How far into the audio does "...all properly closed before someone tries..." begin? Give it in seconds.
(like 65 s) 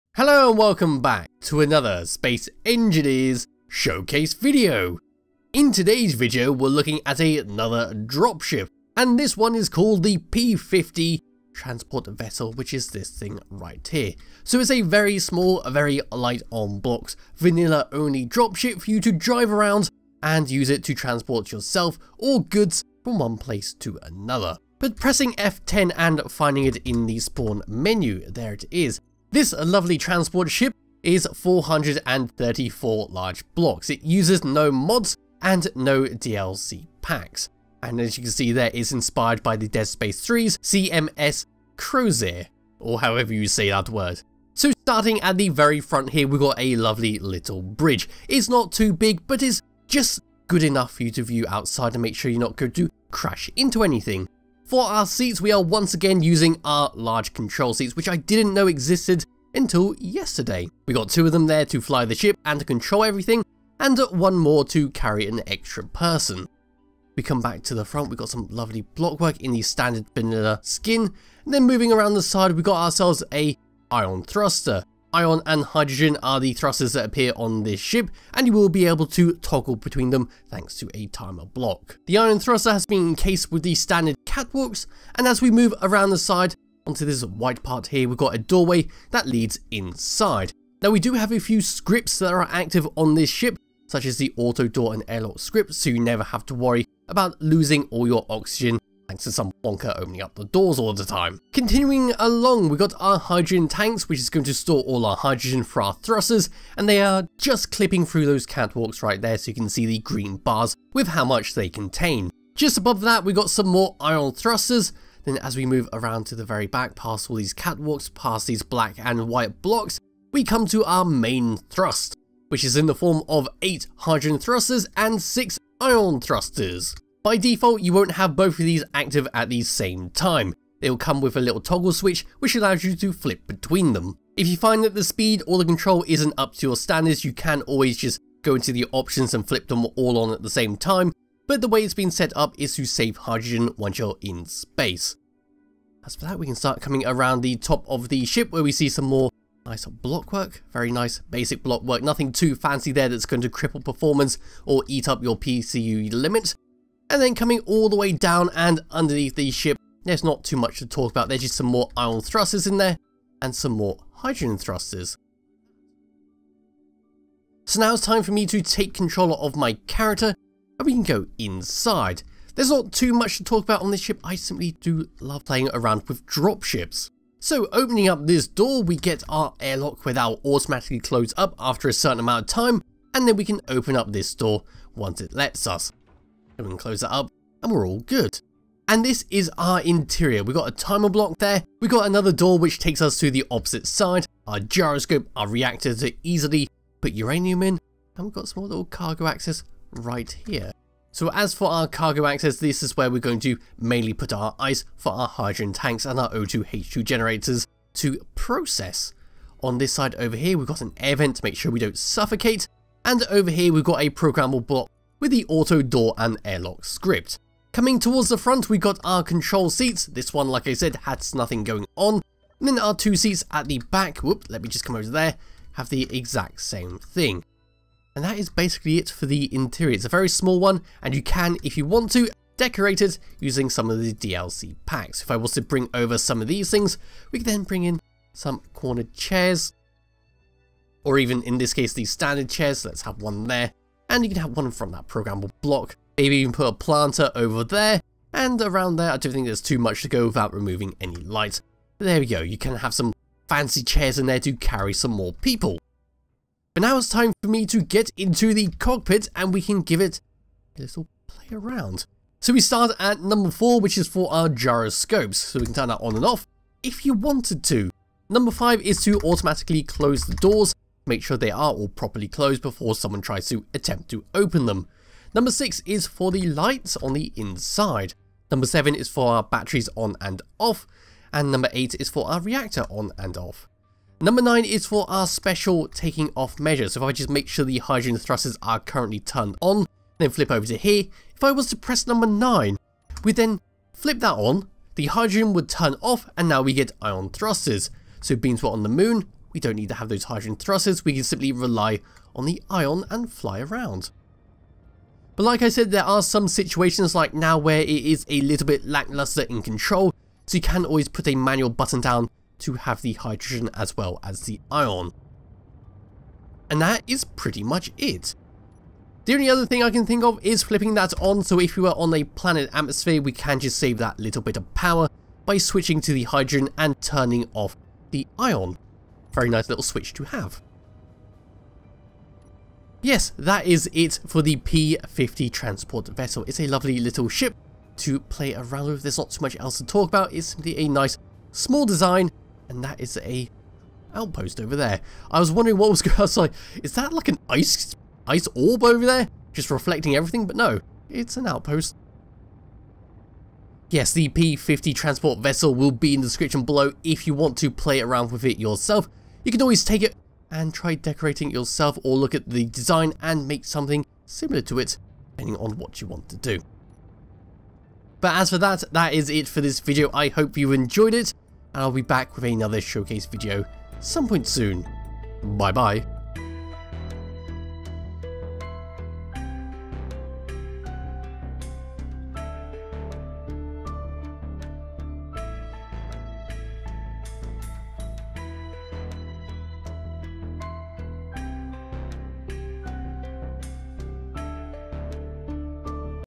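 271 s.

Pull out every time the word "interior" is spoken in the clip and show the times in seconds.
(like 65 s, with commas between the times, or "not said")
189 s, 229 s.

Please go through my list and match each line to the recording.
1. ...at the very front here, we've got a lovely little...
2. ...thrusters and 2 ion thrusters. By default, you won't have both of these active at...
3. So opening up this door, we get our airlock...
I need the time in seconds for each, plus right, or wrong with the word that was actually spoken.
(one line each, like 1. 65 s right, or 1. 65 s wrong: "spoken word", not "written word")
1. 45 s right
2. 124 s wrong: "6", not "2"
3. 177 s right.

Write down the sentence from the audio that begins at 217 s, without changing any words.
Coming towards the front, we got our control seats.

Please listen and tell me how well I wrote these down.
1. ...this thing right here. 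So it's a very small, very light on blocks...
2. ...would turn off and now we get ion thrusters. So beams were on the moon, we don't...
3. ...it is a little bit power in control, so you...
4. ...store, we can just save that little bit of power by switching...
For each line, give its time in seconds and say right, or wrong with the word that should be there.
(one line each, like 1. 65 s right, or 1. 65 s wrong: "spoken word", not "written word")
1. 12 s right
2. 295 s right
3. 307 s wrong: "lackluster", not "power"
4. 322 s wrong: "atmosphere", not "store".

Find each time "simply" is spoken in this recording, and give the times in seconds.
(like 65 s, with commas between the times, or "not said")
174 s, 301 s, 340 s.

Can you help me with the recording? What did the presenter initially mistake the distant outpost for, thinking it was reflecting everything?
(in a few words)
ice orb.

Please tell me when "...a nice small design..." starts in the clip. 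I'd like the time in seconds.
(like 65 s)
340 s.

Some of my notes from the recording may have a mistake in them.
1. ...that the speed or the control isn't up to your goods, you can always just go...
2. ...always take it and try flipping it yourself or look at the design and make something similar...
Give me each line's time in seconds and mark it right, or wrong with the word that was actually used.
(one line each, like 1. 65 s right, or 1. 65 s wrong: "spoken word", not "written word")
1. 134 s wrong: "standards", not "goods"
2. 359 s wrong: "decorating", not "flipping".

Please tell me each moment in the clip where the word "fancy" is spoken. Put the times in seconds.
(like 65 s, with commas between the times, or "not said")
152 s, 253 s.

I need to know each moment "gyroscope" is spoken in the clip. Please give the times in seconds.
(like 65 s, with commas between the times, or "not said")
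194 s, 264 s.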